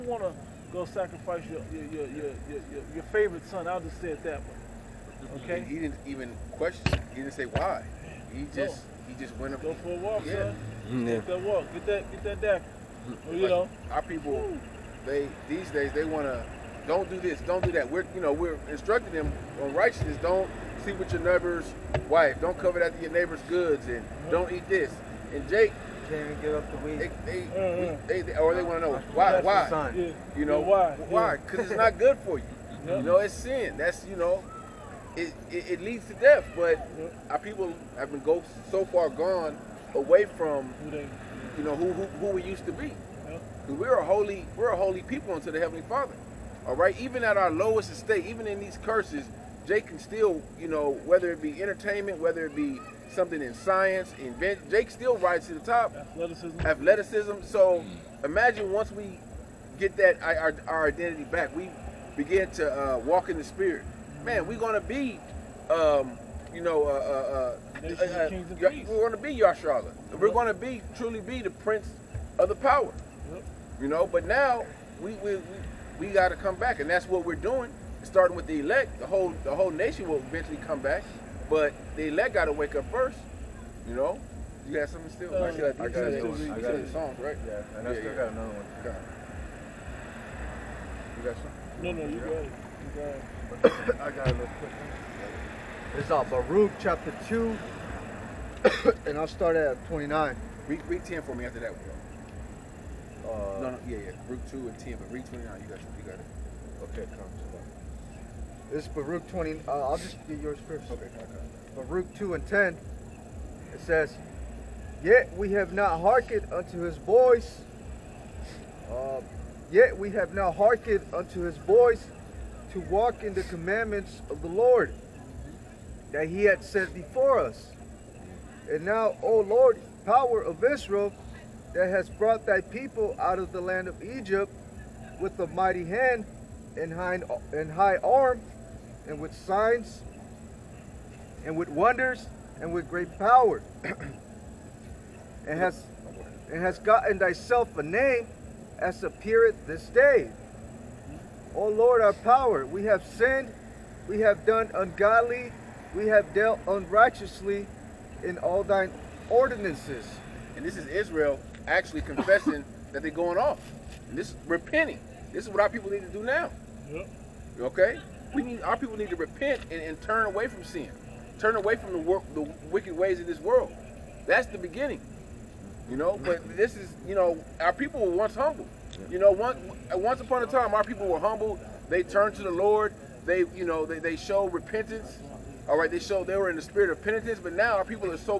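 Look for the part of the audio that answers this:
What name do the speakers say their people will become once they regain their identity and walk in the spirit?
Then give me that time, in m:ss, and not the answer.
1:09.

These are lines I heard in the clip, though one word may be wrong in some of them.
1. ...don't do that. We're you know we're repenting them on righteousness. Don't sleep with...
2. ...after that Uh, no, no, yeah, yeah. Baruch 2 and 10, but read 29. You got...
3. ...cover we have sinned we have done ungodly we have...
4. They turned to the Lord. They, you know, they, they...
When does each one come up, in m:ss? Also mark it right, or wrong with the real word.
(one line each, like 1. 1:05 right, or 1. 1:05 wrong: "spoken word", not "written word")
1. 0:17 wrong: "instructing", not "repenting"
2. 1:41 right
3. 2:32 wrong: "power", not "cover"
4. 3:01 right.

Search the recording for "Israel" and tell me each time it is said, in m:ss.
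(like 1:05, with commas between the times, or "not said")
2:10, 2:40.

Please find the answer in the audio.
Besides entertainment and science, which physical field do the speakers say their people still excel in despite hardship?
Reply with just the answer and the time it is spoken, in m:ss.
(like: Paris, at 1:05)
Athleticism, at 0:55.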